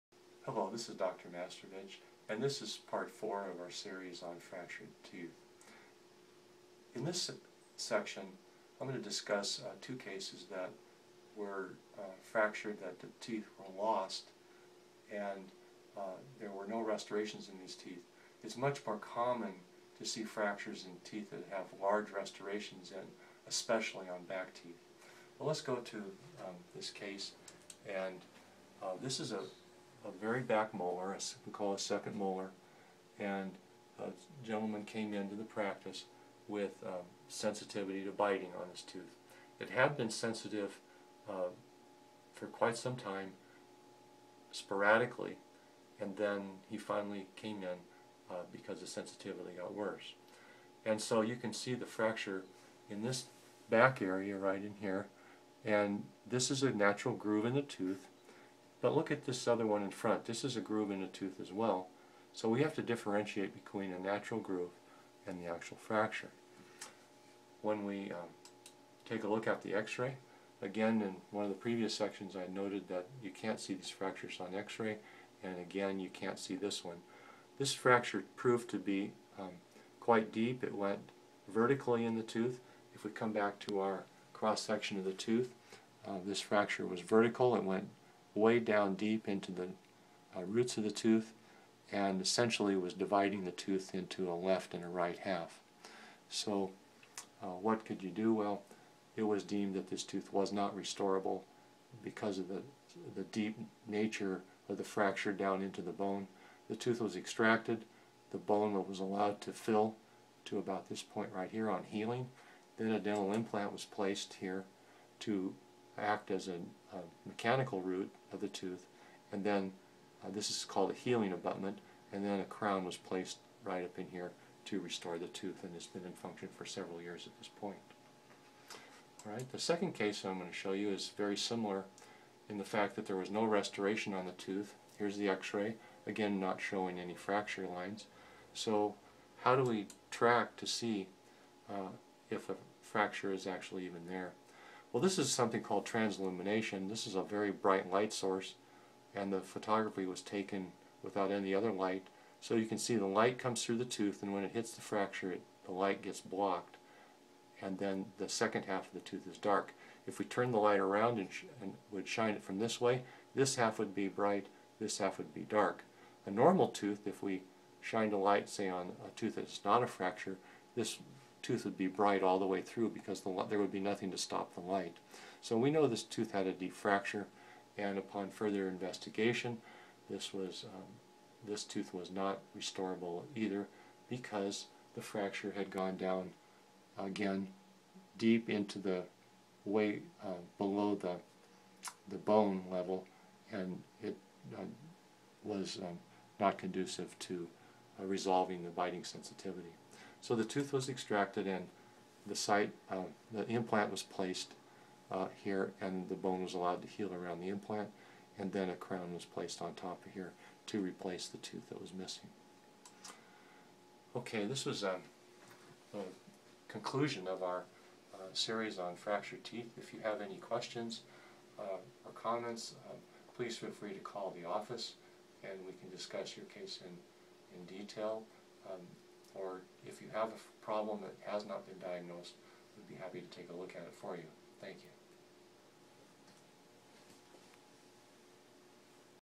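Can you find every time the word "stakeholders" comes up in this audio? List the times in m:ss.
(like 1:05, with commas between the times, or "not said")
not said.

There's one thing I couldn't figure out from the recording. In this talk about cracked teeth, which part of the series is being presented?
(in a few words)
Part 4.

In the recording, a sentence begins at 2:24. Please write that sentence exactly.
Well, this is something called transillumination.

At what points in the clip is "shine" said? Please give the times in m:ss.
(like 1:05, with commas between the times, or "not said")
2:42, 2:47.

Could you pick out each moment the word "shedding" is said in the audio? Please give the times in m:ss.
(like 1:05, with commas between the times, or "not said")
not said.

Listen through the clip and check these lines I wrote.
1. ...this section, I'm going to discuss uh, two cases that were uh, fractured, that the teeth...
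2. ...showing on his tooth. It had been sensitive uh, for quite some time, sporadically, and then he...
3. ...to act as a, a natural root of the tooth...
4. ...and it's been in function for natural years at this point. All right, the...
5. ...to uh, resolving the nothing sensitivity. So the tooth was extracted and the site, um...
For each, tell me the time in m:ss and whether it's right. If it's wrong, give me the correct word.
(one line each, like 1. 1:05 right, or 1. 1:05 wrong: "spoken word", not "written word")
1. 0:07 right
2. 0:38 wrong: "biting", not "showing"
3. 1:55 wrong: "mechanical", not "natural"
4. 2:05 wrong: "several", not "natural"
5. 3:17 wrong: "biting", not "nothing".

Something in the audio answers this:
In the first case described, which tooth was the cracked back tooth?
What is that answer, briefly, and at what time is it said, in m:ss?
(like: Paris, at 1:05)
Second molar, at 0:31.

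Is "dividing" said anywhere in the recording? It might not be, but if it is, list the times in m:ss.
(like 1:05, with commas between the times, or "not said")
1:32.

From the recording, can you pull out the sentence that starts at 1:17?
This fracture proved to be um, quite deep.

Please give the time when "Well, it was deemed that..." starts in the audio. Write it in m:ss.
1:38.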